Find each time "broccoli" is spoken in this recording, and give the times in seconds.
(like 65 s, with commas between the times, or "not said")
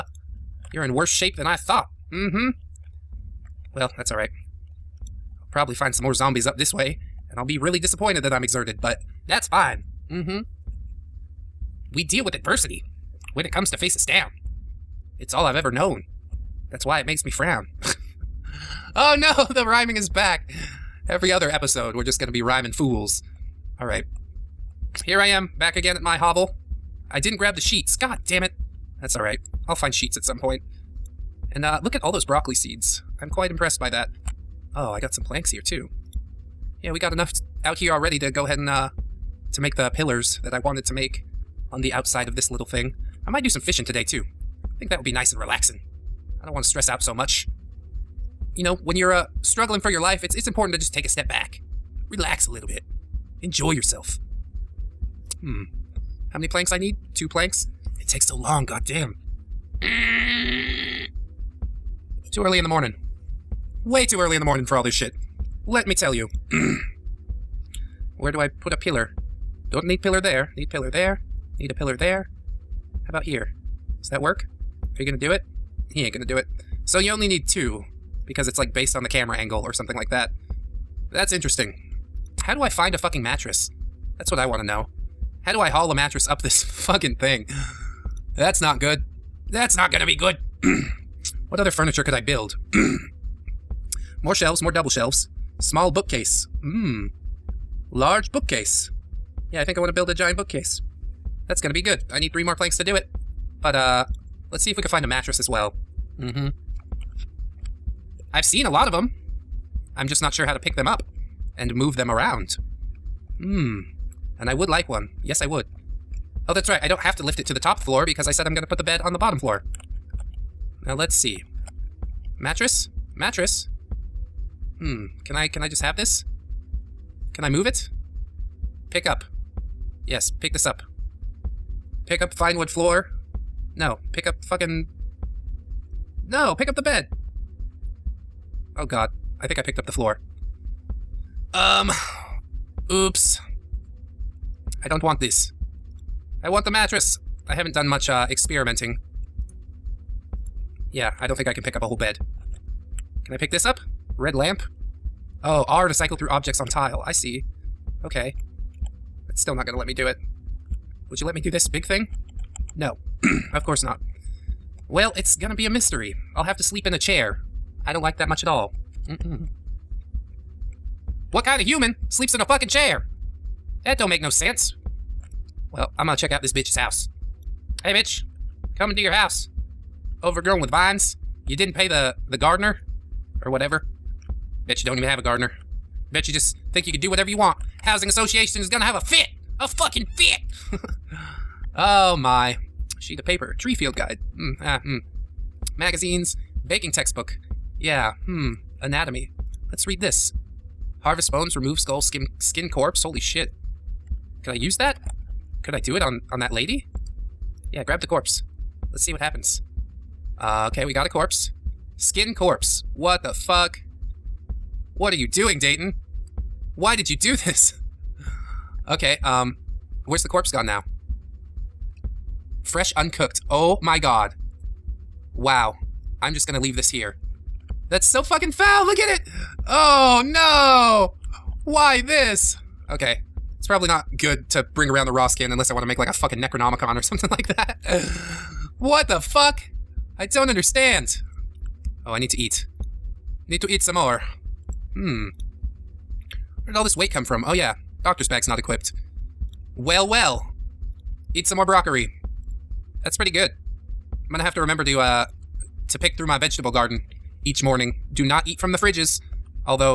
32 s, 251 s.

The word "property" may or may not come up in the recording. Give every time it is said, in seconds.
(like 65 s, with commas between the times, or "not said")
not said.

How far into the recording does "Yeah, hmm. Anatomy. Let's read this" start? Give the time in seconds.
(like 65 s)
197 s.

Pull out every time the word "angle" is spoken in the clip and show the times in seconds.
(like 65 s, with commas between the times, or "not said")
79 s.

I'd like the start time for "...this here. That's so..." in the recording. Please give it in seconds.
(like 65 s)
226 s.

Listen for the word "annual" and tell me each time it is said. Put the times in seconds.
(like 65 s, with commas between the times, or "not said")
not said.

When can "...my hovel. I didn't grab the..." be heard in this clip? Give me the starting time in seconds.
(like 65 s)
26 s.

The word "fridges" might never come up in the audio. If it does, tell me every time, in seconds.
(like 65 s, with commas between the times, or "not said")
258 s.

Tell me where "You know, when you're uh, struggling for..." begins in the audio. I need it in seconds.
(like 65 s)
48 s.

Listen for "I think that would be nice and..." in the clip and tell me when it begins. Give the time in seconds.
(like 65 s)
44 s.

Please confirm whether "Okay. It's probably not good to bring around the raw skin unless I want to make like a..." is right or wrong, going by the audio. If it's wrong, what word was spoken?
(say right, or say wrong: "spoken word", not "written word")
right.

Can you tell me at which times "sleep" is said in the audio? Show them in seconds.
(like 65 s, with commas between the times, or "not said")
166 s, 172 s.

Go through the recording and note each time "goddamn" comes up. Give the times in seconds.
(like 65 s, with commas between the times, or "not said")
58 s.